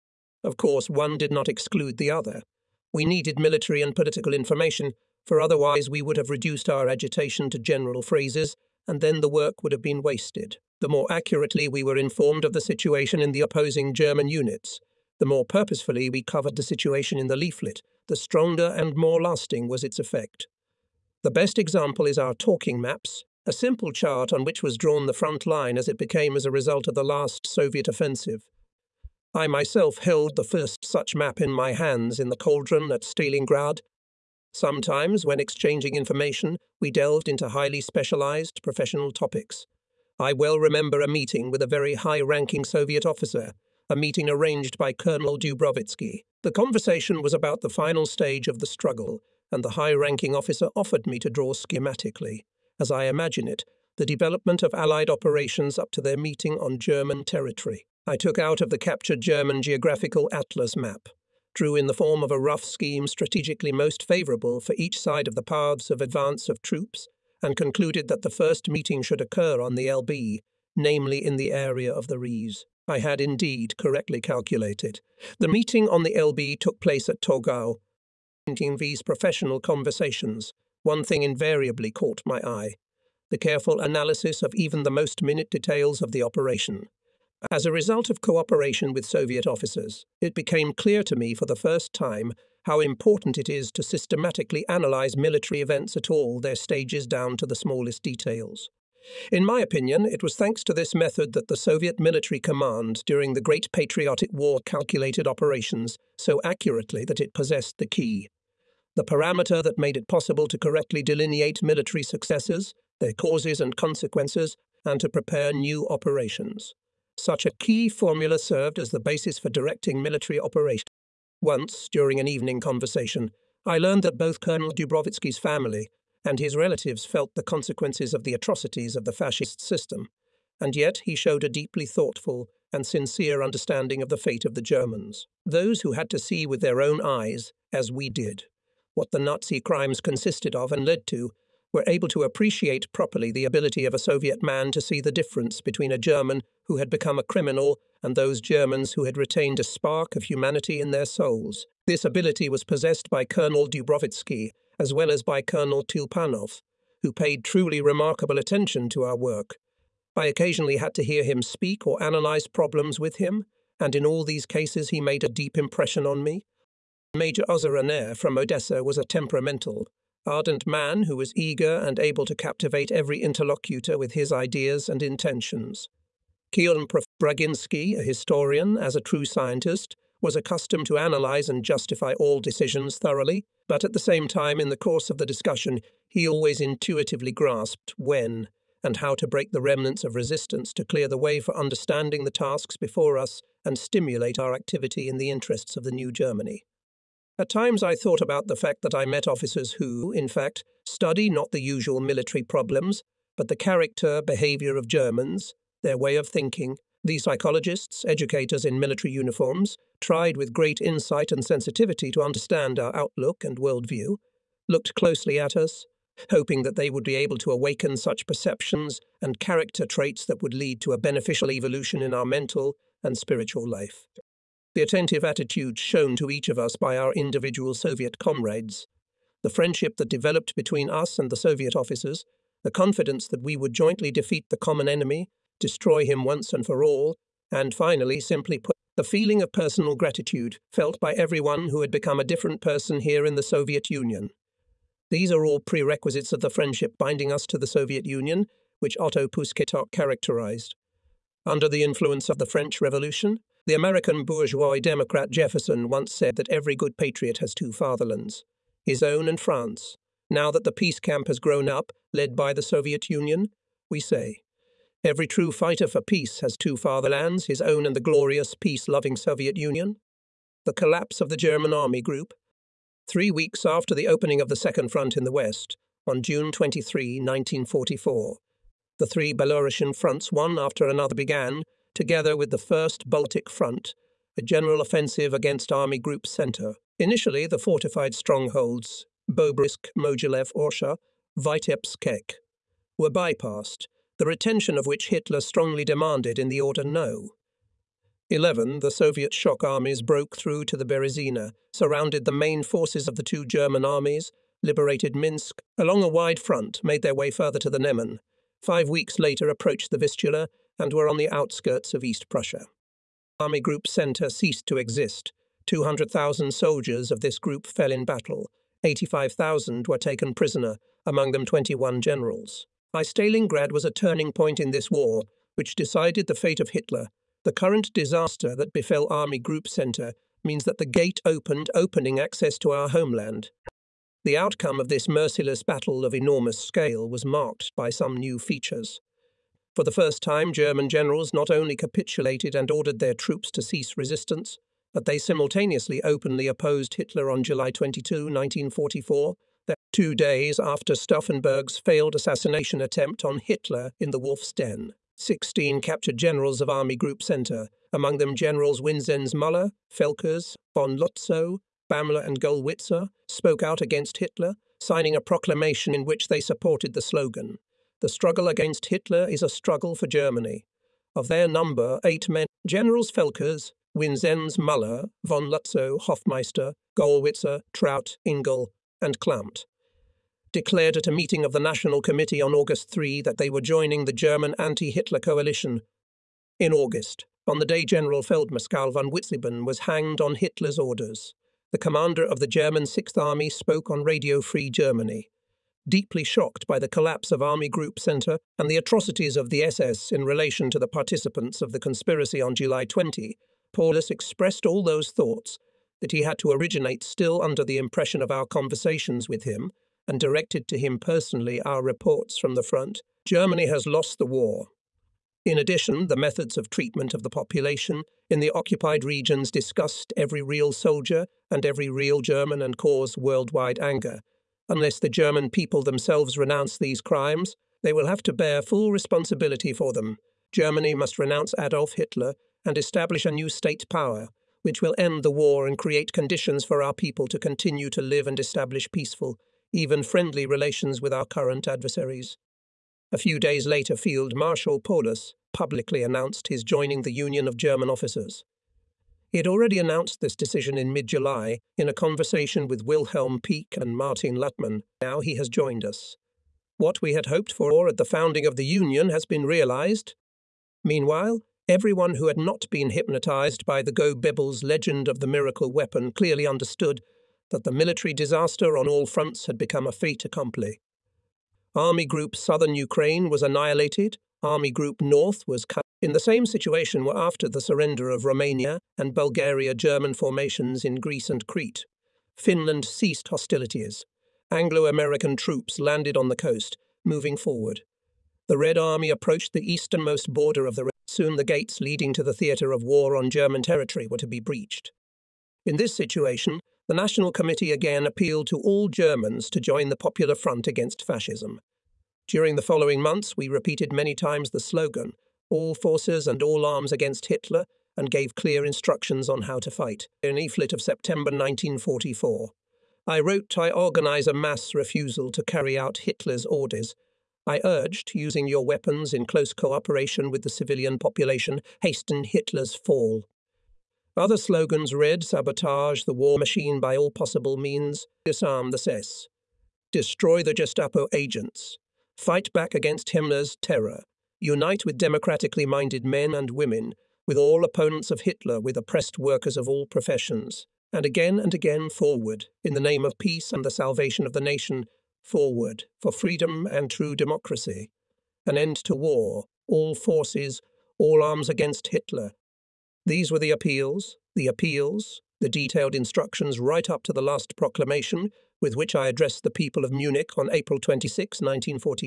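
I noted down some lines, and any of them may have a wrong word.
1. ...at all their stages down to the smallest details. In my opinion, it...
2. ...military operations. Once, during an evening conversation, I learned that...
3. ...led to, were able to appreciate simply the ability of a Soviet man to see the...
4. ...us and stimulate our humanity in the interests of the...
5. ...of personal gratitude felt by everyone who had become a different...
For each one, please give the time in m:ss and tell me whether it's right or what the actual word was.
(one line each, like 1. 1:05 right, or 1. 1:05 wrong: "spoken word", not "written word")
1. 1:35 right
2. 2:00 right
3. 2:20 wrong: "properly", not "simply"
4. 3:13 wrong: "activity", not "humanity"
5. 3:59 right.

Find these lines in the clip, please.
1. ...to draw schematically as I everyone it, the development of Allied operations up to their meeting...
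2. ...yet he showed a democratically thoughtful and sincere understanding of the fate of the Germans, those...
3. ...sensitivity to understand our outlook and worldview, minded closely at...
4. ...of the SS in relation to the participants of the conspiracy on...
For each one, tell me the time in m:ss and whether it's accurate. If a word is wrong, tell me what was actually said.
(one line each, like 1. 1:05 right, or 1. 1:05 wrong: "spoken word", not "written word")
1. 0:51 wrong: "imagine", not "everyone"
2. 2:10 wrong: "deeply", not "democratically"
3. 3:31 wrong: "looked", not "minded"
4. 6:39 right.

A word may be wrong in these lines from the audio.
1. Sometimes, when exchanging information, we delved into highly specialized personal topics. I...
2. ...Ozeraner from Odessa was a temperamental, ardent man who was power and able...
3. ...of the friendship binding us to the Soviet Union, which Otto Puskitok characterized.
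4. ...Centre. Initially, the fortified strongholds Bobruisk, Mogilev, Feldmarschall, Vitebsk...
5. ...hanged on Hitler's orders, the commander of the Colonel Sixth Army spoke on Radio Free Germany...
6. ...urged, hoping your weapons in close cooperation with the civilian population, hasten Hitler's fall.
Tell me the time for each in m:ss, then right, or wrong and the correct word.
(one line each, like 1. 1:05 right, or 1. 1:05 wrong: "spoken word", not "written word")
1. 0:34 wrong: "professional", not "personal"
2. 2:47 wrong: "eager", not "power"
3. 4:06 right
4. 4:46 wrong: "Orsha", not "Feldmarschall"
5. 6:29 wrong: "German", not "Colonel"
6. 8:37 wrong: "using", not "hoping".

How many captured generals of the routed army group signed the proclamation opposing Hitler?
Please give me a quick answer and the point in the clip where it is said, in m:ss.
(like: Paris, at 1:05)
16, at 5:55.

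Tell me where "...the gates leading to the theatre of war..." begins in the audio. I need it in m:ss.
8:11.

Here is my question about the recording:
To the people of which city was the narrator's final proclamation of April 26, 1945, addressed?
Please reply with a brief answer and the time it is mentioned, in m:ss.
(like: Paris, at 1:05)
Munich, at 9:19.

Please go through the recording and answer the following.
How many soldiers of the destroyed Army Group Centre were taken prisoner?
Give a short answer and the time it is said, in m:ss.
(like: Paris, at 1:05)
85,000, at 5:18.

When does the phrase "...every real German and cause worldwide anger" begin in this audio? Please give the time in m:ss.
7:01.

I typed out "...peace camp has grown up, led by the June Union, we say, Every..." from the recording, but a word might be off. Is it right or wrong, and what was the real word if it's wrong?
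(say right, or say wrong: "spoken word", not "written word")
wrong: "Soviet", not "June".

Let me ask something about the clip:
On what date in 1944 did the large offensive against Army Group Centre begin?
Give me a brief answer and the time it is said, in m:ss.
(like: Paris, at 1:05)
June 23, at 4:36.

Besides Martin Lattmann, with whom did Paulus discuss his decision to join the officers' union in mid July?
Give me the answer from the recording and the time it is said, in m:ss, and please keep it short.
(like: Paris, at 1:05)
Wilhelm Pieck, at 7:32.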